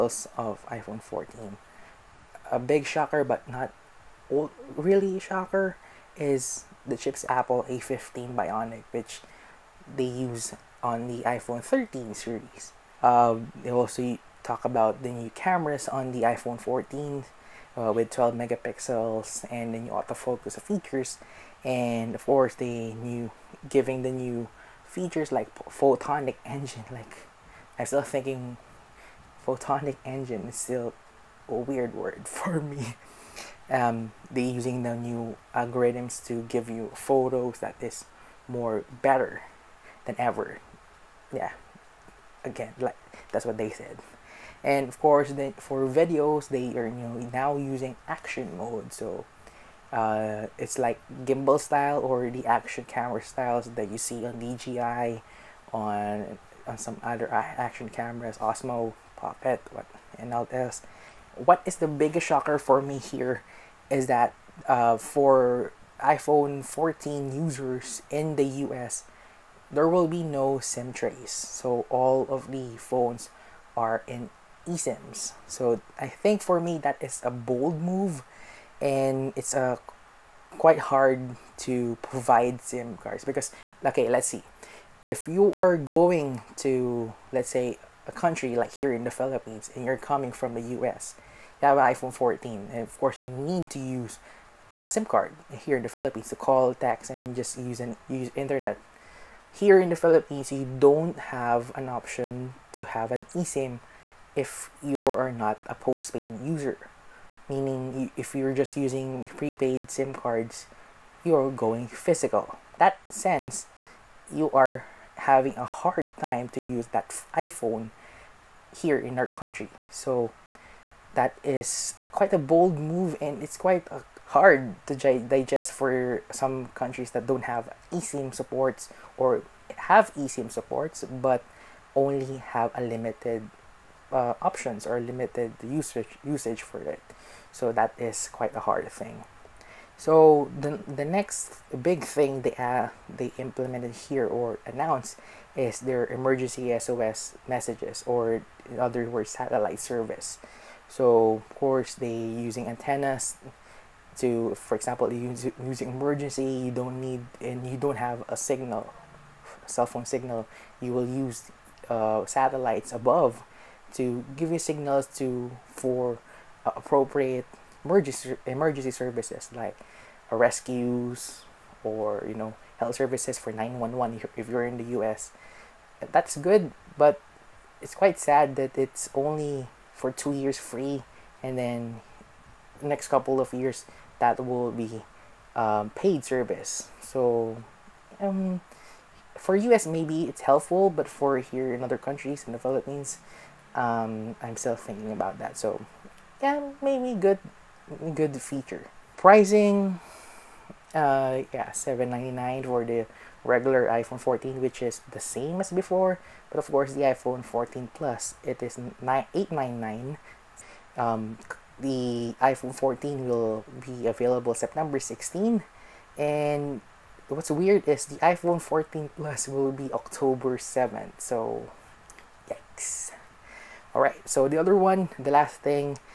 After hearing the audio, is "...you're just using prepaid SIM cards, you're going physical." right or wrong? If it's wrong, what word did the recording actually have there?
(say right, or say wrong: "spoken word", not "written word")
right.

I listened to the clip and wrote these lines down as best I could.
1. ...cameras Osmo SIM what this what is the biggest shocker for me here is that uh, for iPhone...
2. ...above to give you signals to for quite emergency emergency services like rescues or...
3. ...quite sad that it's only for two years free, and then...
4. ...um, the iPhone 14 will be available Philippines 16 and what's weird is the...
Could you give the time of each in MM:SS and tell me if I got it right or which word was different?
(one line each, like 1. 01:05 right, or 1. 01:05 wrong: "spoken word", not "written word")
1. 00:57 wrong: "Pocket", not "SIM"
2. 02:42 wrong: "appropriate", not "quite"
3. 02:57 right
4. 03:30 wrong: "September", not "Philippines".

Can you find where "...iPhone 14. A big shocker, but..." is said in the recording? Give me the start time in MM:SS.
00:00.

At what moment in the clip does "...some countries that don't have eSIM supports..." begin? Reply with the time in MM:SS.
02:06.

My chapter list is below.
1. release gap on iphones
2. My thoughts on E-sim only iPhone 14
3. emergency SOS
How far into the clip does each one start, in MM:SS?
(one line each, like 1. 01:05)
1. 03:30
2. 01:16
3. 02:19.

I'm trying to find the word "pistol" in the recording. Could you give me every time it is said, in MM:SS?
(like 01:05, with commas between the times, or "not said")
not said.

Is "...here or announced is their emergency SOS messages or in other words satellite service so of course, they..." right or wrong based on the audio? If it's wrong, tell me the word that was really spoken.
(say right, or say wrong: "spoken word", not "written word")
right.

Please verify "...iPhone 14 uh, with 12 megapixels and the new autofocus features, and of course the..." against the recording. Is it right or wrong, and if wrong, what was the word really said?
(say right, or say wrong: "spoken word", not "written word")
right.